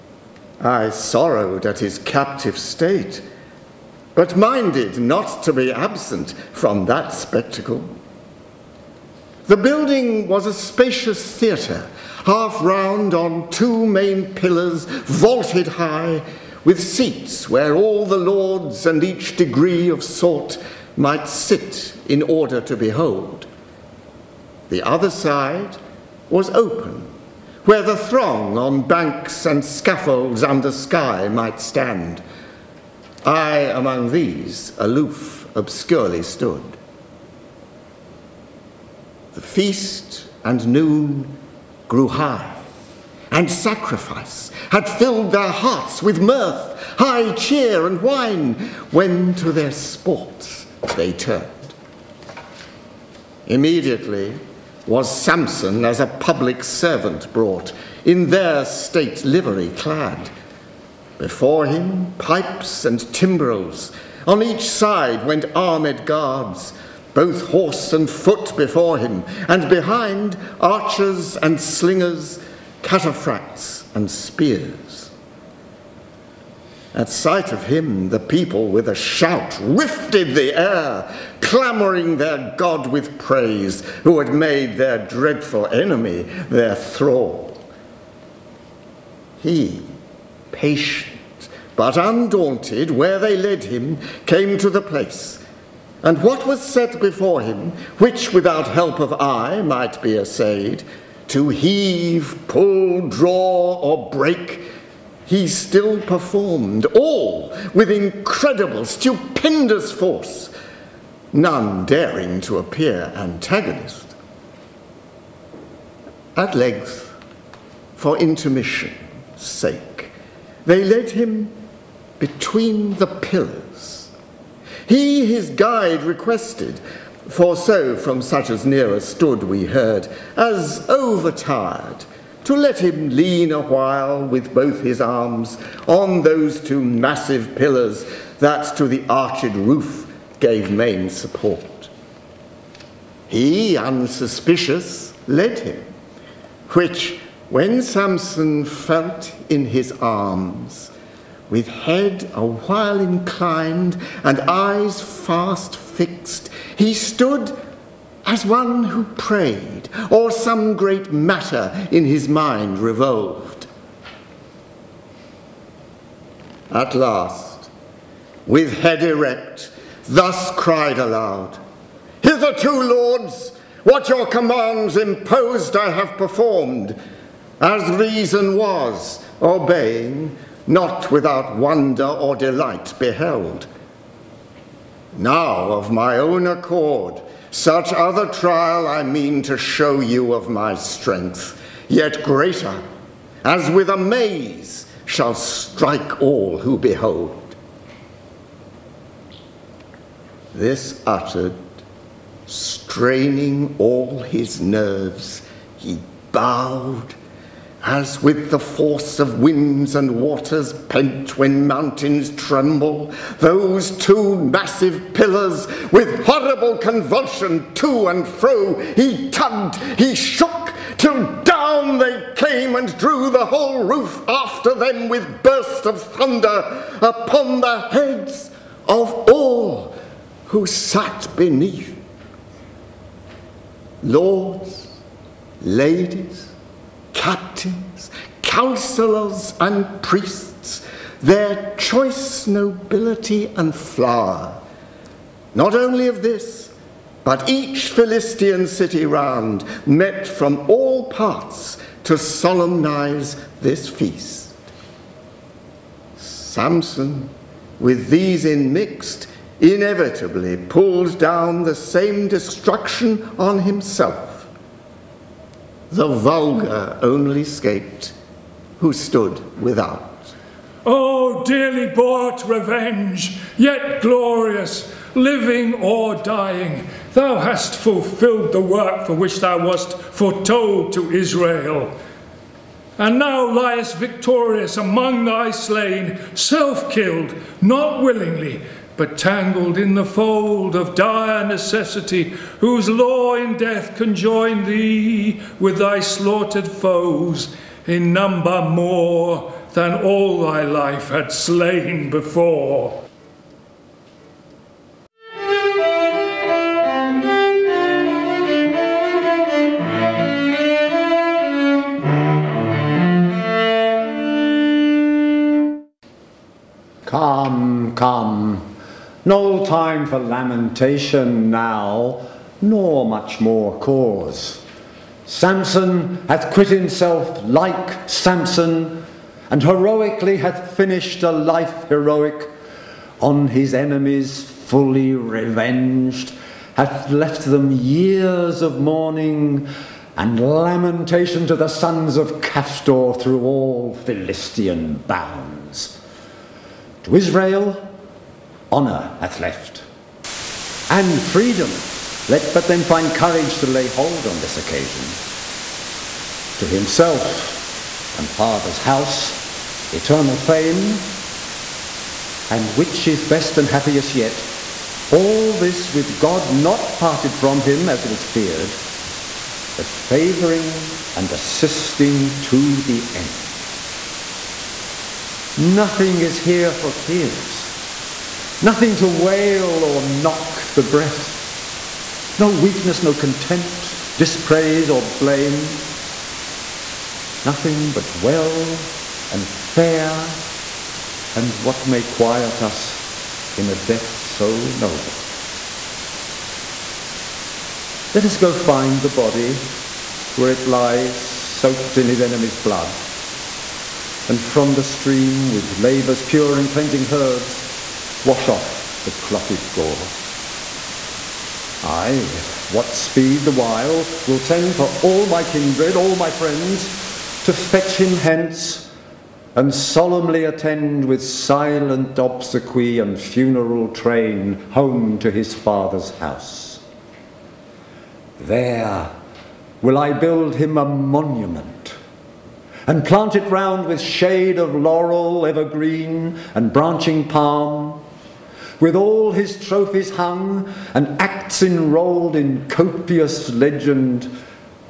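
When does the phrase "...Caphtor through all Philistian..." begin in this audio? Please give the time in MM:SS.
05:42.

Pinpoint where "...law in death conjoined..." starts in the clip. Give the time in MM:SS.
04:52.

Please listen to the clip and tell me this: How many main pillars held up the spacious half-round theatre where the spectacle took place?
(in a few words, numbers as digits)
2.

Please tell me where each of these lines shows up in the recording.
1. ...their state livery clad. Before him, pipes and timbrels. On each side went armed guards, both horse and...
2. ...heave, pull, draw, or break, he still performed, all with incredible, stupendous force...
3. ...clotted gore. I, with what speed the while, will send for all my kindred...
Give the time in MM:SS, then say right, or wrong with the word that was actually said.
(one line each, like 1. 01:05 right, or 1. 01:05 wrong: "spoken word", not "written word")
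1. 00:58 right
2. 01:41 right
3. 06:49 right.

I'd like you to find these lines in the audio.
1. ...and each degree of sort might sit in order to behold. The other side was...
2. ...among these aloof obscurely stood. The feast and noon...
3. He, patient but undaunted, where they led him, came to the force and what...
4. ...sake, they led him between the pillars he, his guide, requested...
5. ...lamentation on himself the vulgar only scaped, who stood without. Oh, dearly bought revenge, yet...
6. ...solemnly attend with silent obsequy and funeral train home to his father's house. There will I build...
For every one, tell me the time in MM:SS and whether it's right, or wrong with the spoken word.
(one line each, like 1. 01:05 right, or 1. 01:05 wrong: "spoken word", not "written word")
1. 00:18 right
2. 00:33 right
3. 01:29 wrong: "place", not "force"
4. 01:59 right
5. 04:22 wrong: "destruction", not "lamentation"
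6. 06:59 right.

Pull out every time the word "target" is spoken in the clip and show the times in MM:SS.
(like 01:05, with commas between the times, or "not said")
not said.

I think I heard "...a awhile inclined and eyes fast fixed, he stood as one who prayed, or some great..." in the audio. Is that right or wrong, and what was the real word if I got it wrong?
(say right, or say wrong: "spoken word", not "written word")
wrong: "while", not "awhile".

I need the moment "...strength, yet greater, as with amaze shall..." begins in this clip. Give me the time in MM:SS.
03:10.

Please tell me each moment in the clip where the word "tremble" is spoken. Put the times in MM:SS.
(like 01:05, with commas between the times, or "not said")
03:32.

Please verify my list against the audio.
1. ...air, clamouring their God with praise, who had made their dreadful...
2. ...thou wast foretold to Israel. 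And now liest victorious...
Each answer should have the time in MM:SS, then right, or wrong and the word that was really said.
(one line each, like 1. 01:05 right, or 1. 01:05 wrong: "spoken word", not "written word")
1. 01:20 right
2. 04:39 right.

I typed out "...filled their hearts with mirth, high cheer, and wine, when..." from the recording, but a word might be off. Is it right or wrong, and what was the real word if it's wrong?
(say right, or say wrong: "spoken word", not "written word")
right.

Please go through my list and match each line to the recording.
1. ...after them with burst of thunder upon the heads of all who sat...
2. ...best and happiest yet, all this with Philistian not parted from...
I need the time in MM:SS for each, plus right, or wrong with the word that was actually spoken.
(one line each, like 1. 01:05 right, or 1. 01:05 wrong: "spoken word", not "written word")
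1. 03:44 right
2. 06:03 wrong: "God", not "Philistian".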